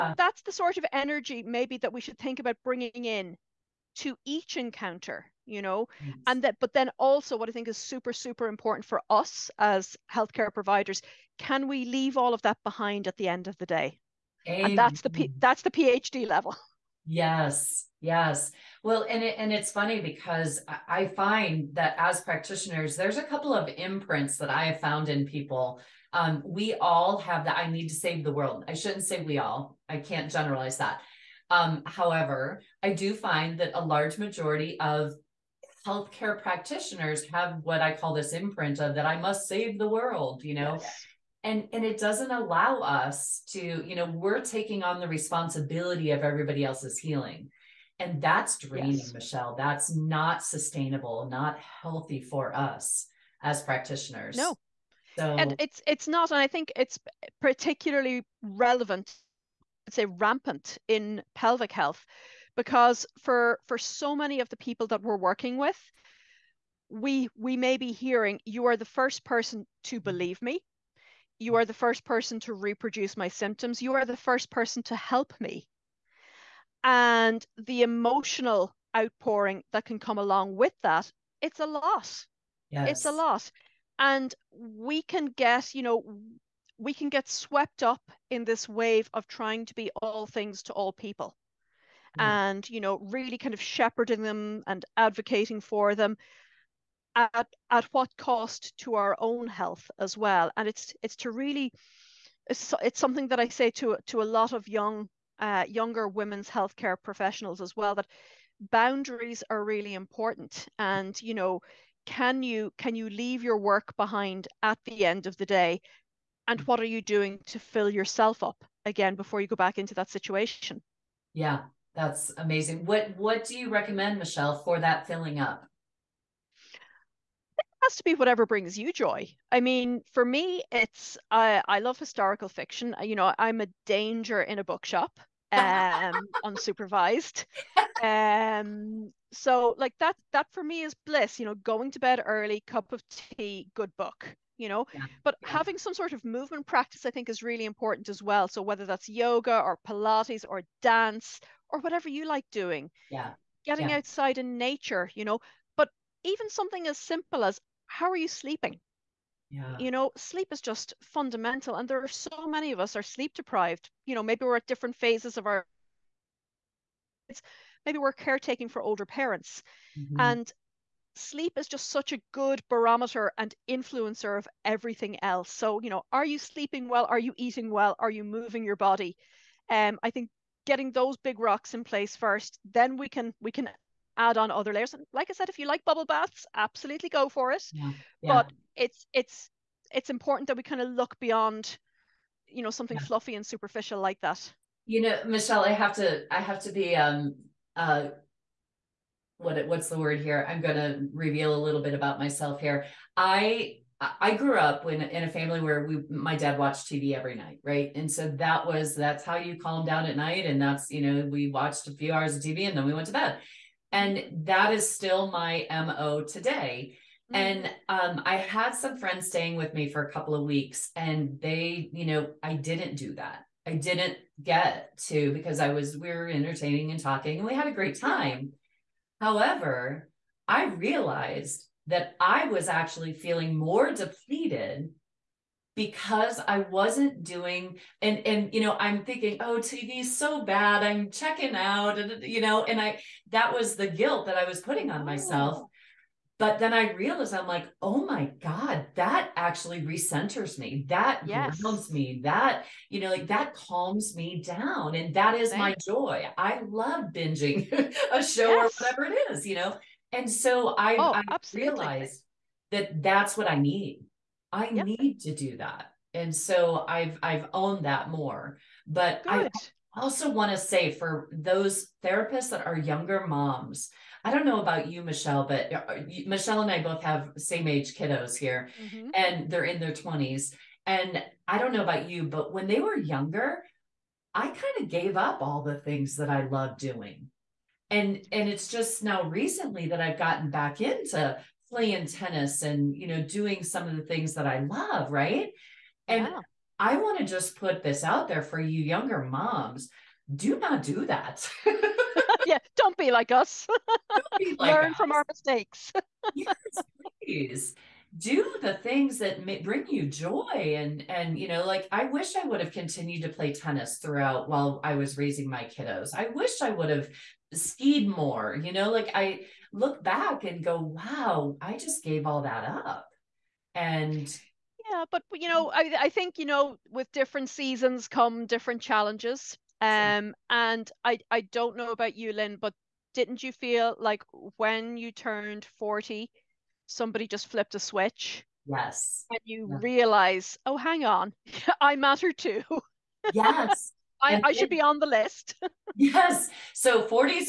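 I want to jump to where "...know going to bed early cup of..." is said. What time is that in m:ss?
2:21.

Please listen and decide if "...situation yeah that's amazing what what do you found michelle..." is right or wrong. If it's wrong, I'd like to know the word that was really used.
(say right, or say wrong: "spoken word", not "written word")
wrong: "recommend", not "found".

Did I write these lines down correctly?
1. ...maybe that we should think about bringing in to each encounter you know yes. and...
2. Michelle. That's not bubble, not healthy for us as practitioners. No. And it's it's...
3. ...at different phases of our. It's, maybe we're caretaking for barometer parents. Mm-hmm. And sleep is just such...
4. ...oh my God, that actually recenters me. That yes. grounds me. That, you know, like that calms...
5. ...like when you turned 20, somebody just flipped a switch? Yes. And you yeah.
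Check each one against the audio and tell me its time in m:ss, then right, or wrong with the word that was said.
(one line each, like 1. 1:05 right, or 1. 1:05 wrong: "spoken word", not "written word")
1. 0:01 right
2. 0:49 wrong: "sustainable", not "bubble"
3. 2:44 wrong: "older", not "barometer"
4. 4:07 right
5. 5:33 wrong: "40", not "20".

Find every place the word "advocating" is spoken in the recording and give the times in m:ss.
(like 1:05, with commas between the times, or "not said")
1:34.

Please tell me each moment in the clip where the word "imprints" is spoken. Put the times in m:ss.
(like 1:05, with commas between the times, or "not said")
0:23, 0:38.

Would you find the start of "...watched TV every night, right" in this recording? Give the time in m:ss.
3:26.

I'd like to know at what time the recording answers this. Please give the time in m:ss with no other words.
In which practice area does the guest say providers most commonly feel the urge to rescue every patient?
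1:01.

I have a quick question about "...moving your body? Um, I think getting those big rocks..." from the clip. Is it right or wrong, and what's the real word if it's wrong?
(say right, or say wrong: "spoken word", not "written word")
right.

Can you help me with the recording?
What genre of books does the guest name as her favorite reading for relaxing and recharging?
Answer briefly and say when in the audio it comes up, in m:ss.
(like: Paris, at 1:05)
historical fiction, at 2:11.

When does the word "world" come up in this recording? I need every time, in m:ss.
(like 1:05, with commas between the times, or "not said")
0:28, 0:39.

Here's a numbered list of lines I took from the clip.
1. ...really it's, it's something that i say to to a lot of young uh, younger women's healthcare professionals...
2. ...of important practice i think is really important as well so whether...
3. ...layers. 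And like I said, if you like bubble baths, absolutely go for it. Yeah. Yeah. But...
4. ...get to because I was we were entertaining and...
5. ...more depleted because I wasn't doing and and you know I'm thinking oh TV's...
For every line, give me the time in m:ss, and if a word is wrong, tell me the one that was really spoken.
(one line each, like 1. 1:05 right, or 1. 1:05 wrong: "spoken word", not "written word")
1. 1:41 right
2. 2:26 wrong: "movement", not "important"
3. 3:04 right
4. 3:44 right
5. 3:53 right.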